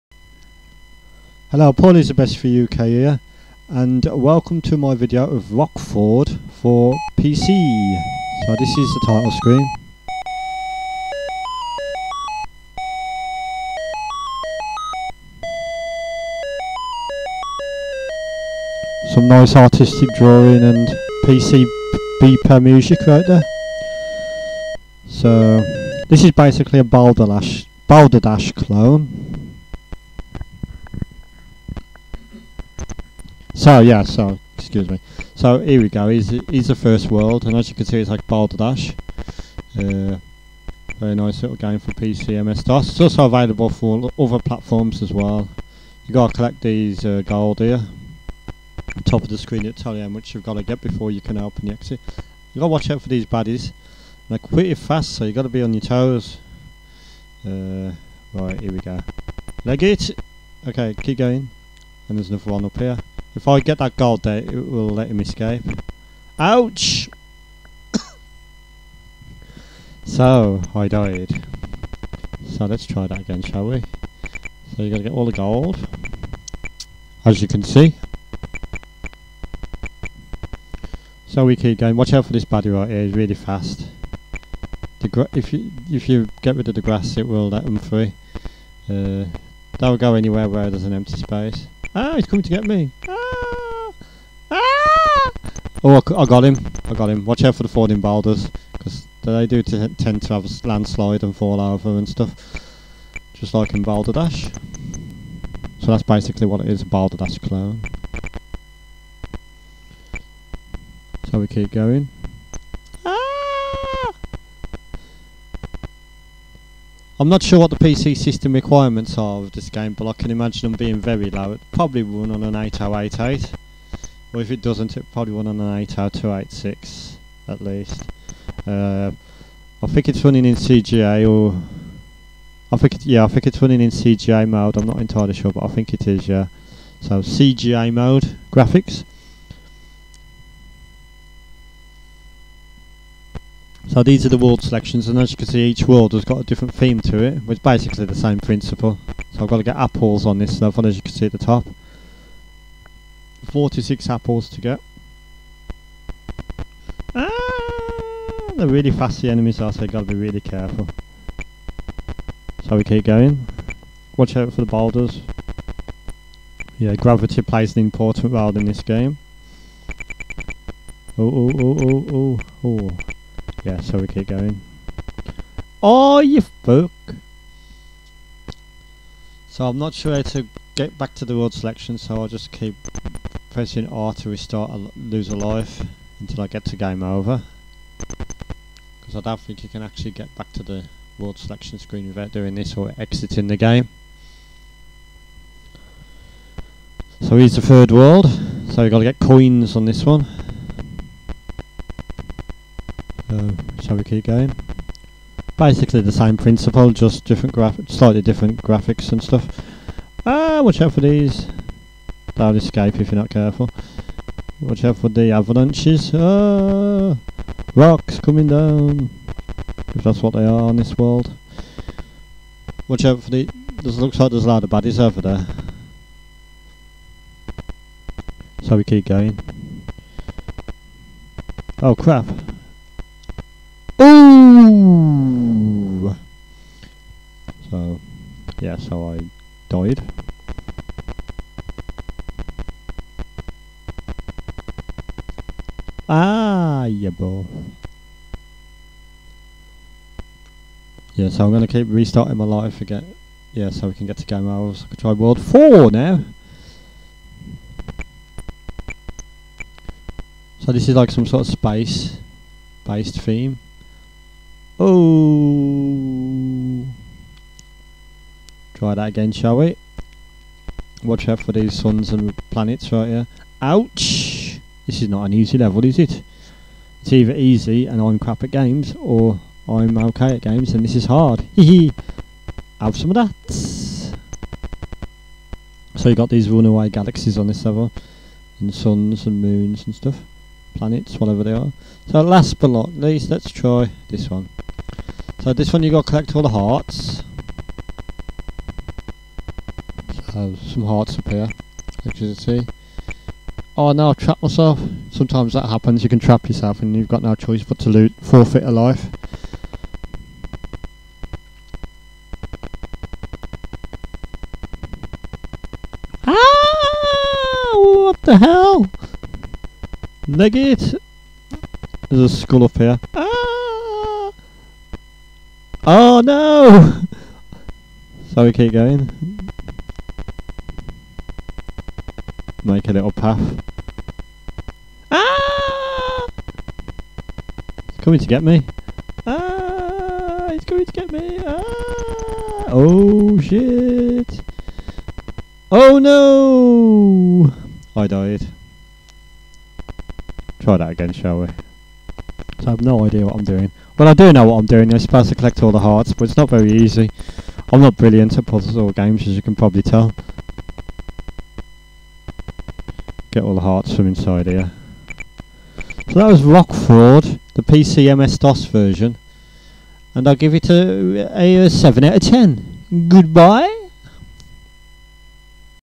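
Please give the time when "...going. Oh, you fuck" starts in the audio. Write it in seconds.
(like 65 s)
174 s.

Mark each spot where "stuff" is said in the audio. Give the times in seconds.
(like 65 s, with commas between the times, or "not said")
102 s, 150 s, 209 s, 289 s.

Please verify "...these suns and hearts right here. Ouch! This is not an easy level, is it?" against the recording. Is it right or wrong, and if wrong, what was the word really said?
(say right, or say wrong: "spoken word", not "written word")
wrong: "planets", not "hearts".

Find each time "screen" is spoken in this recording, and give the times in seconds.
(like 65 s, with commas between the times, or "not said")
9 s, 49 s, 191 s.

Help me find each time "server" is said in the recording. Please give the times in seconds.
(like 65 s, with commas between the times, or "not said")
287 s.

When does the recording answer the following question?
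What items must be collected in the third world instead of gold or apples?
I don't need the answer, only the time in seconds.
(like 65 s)
199 s.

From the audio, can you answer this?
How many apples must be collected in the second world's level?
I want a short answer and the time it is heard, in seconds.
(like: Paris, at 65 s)
46, at 153 s.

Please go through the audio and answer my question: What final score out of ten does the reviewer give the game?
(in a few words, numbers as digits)
7.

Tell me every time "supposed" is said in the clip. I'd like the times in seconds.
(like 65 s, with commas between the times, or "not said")
354 s.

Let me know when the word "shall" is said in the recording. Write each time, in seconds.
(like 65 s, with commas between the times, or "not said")
73 s, 203 s, 269 s, 351 s.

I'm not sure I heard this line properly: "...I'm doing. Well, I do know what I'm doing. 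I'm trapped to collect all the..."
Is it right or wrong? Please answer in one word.
wrong.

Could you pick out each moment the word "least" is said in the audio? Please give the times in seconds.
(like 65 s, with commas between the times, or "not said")
127 s, 292 s.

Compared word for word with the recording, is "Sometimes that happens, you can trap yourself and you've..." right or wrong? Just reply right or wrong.
right.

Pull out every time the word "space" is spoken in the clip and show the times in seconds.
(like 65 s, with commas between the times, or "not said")
91 s, 261 s.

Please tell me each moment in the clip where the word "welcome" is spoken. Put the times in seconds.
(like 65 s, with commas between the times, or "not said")
4 s.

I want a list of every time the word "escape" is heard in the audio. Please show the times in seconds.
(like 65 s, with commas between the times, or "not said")
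65 s, 212 s.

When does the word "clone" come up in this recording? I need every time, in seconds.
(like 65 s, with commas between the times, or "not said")
28 s, 107 s.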